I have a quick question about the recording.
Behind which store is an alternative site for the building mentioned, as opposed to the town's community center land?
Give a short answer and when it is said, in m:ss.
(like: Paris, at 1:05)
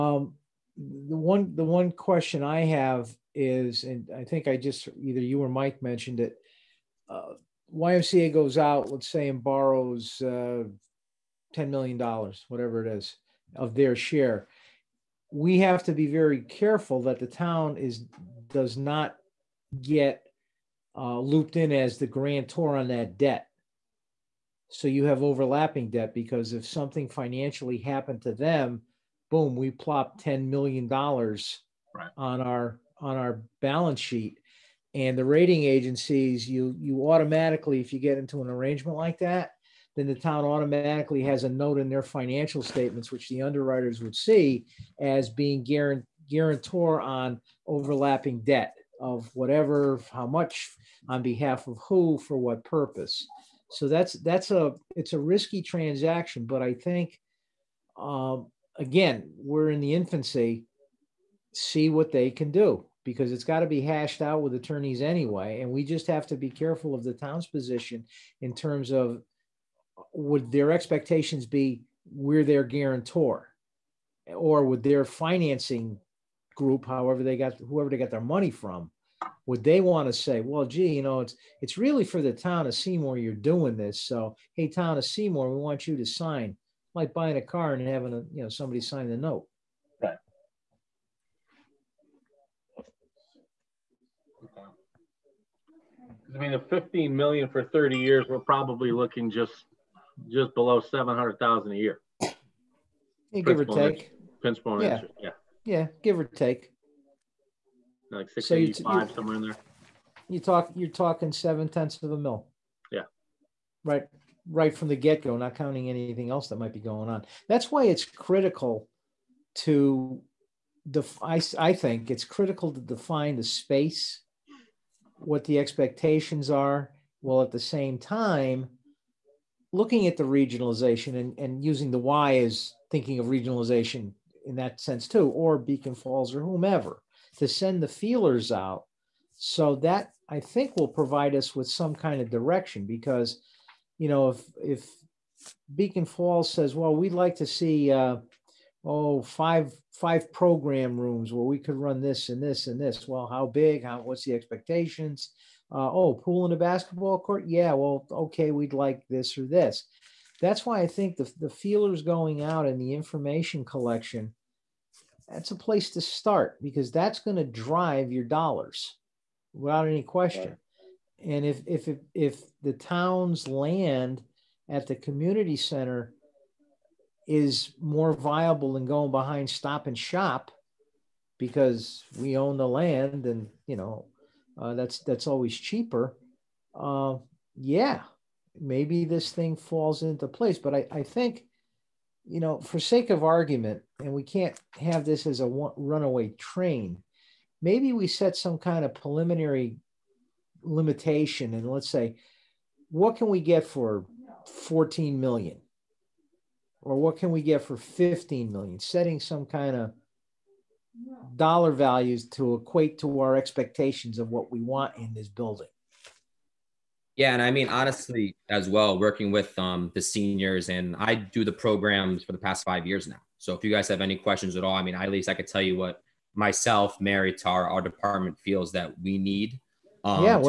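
Stop and Shop, at 2:59.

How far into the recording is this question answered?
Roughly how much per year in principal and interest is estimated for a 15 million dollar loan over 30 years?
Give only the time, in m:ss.
1:40.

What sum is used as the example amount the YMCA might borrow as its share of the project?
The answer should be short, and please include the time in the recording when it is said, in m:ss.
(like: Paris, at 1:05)
$10 million, at 0:11.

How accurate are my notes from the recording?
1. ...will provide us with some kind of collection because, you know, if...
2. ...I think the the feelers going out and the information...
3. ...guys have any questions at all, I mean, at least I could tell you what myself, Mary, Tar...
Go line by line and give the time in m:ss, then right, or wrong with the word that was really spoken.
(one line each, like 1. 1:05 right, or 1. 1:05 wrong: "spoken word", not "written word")
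1. 2:20 wrong: "direction", not "collection"
2. 2:40 right
3. 3:43 right.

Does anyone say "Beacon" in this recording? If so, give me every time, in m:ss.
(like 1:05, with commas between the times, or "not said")
2:15, 2:25.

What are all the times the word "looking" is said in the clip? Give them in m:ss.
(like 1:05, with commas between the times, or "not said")
1:38, 2:09.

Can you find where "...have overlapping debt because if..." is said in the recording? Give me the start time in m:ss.
0:25.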